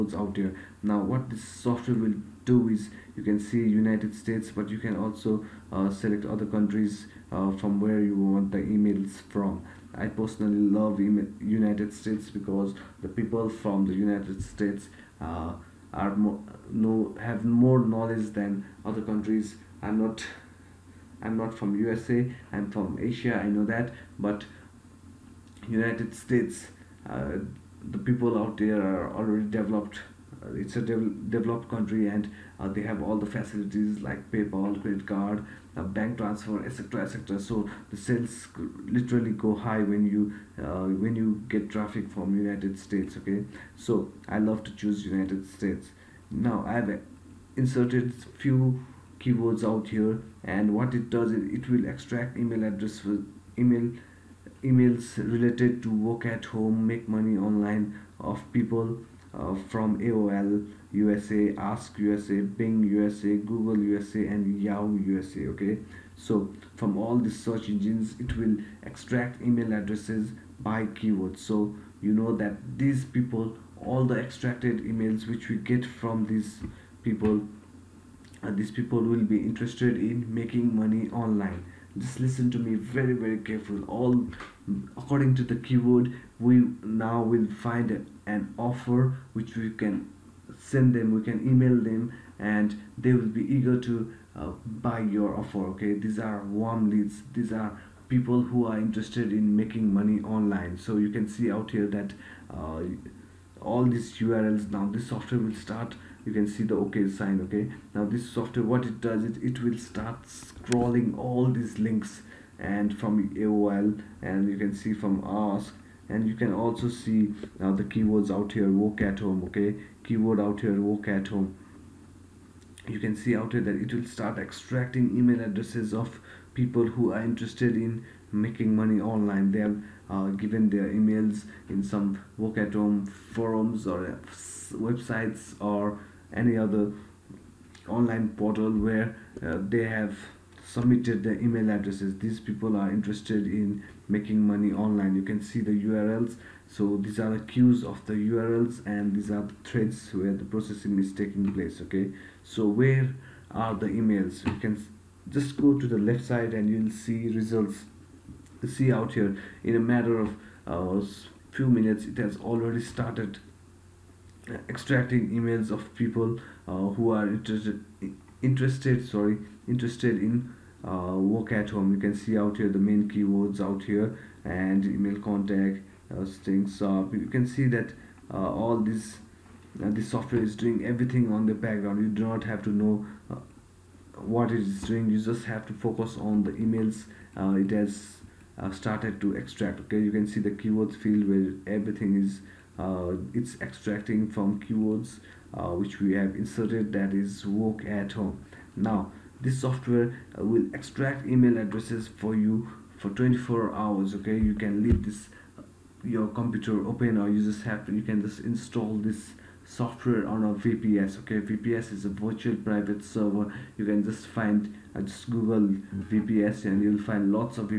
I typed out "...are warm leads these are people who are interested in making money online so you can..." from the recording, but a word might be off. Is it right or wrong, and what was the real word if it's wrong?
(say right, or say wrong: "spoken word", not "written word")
right.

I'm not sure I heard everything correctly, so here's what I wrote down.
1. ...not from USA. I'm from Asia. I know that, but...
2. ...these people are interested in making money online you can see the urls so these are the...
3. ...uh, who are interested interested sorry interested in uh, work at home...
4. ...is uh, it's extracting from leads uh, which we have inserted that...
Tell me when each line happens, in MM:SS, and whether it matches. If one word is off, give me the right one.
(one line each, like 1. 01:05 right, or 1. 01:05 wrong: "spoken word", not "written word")
1. 00:21 right
2. 02:22 right
3. 02:46 right
4. 03:12 wrong: "keywords", not "leads".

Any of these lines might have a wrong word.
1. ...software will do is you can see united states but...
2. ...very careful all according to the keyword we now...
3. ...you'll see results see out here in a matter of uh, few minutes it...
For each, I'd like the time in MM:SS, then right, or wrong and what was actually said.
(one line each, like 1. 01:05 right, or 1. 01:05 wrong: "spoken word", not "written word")
1. 00:01 right
2. 01:23 right
3. 02:36 right.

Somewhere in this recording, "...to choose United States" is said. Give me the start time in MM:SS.
00:44.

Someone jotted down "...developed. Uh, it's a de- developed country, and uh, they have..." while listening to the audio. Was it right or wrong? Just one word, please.
right.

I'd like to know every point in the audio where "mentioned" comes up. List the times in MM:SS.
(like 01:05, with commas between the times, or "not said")
not said.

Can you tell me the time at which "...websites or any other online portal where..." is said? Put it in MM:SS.
02:14.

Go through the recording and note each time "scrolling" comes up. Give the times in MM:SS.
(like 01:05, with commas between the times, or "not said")
01:50.